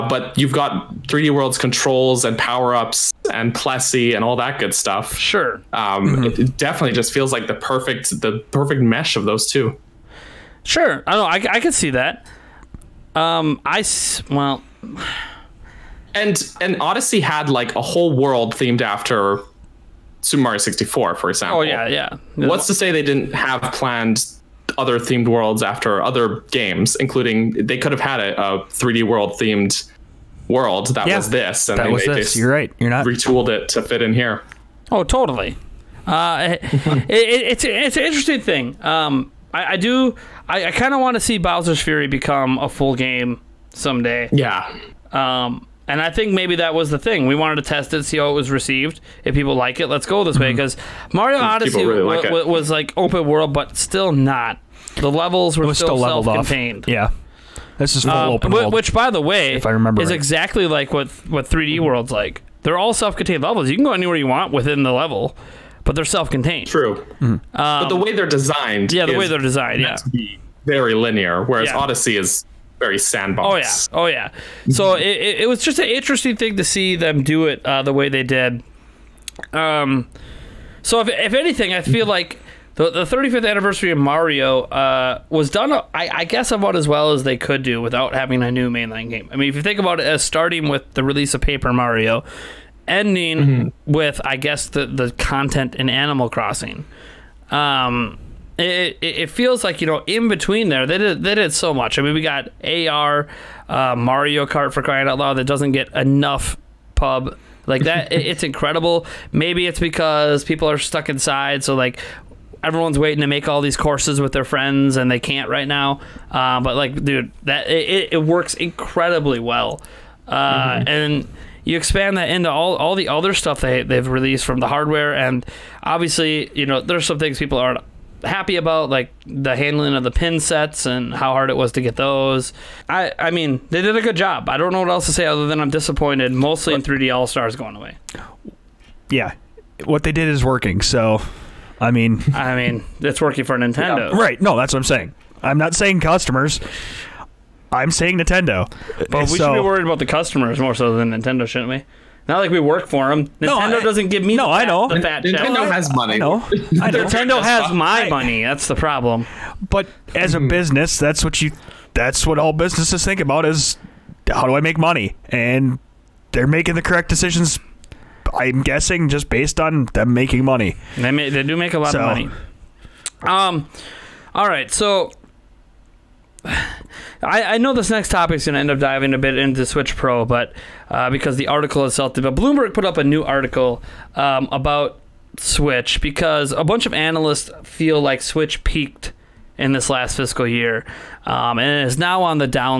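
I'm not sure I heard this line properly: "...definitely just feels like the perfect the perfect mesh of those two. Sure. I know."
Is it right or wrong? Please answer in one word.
right.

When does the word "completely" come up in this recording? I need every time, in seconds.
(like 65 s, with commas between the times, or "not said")
not said.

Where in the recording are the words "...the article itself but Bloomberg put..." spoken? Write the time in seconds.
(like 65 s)
181 s.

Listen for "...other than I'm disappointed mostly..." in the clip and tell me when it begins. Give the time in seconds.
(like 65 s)
135 s.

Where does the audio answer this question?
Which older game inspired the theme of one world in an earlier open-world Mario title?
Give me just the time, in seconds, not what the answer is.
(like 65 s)
20 s.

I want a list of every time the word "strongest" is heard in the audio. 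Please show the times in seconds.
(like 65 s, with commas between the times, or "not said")
not said.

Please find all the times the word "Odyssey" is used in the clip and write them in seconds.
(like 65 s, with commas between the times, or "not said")
16 s, 51 s, 71 s.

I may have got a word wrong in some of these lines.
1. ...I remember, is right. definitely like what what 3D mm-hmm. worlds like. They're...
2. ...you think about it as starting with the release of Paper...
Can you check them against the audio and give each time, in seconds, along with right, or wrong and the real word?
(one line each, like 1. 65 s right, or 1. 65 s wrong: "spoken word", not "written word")
1. 59 s wrong: "exactly", not "definitely"
2. 89 s right.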